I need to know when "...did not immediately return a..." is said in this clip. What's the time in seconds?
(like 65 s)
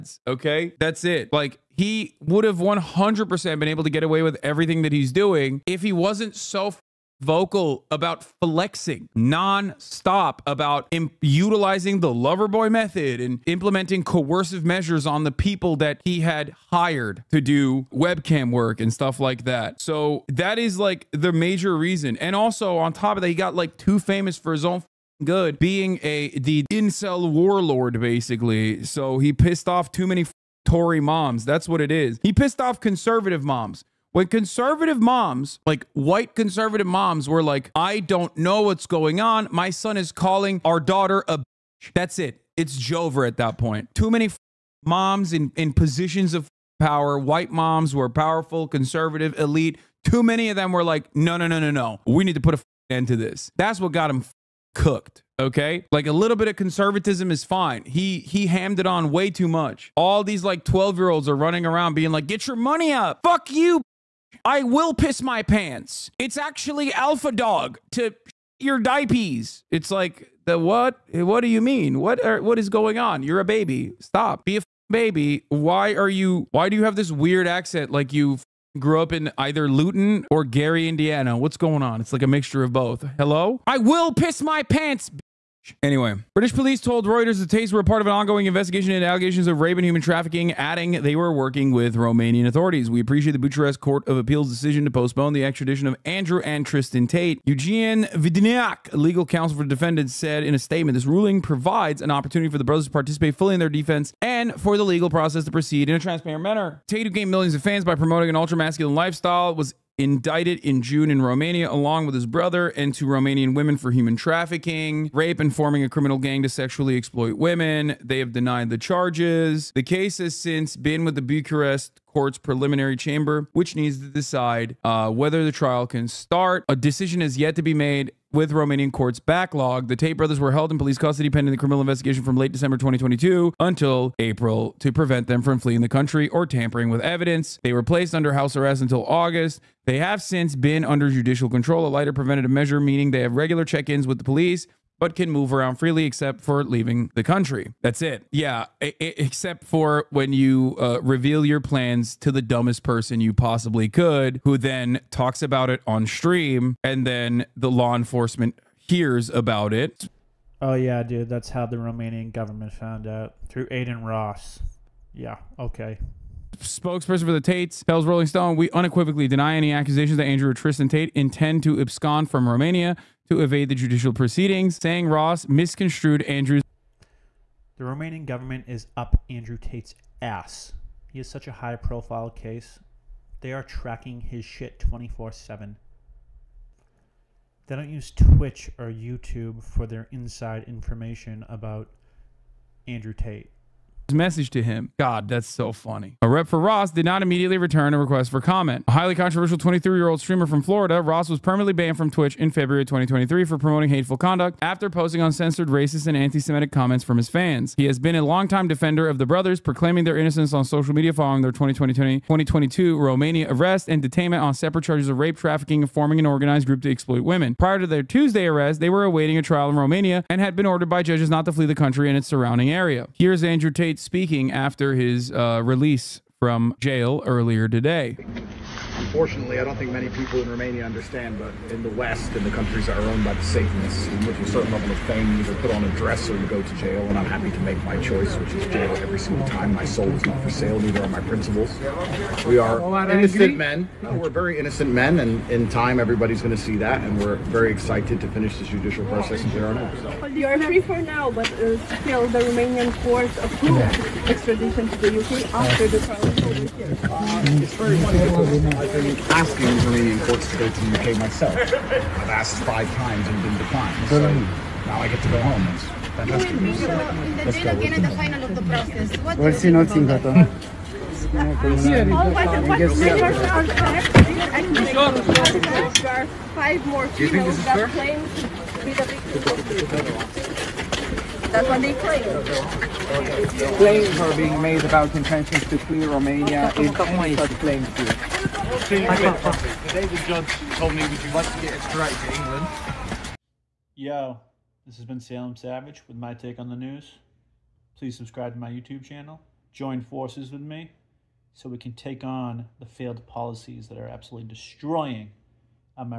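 196 s.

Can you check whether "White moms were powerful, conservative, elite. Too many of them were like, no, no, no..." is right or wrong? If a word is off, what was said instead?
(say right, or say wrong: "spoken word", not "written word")
right.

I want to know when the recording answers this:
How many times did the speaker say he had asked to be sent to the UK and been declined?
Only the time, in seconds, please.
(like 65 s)
262 s.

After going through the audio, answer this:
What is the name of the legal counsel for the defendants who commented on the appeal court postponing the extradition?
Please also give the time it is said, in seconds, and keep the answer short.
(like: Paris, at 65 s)
Eugene Vidineac, at 97 s.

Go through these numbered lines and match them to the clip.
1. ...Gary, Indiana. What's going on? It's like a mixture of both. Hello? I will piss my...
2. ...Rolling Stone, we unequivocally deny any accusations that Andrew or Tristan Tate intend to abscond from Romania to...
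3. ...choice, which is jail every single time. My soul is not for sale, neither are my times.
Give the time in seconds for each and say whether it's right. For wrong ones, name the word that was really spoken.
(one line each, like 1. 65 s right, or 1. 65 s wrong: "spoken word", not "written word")
1. 80 s right
2. 168 s right
3. 238 s wrong: "principles", not "times".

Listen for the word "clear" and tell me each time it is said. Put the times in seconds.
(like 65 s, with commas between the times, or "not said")
249 s.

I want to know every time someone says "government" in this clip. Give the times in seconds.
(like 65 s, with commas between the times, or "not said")
162 s, 178 s.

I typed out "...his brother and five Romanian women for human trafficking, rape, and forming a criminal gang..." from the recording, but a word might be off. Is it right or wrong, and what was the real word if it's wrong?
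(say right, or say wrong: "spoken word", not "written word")
wrong: "two", not "five".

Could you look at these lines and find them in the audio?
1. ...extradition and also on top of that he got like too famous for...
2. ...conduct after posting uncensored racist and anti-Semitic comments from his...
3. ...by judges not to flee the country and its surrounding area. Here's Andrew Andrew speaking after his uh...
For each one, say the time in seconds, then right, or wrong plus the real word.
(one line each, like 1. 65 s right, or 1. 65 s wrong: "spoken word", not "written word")
1. 21 s wrong: "reason", not "extradition"
2. 204 s right
3. 220 s wrong: "Tate", not "Andrew".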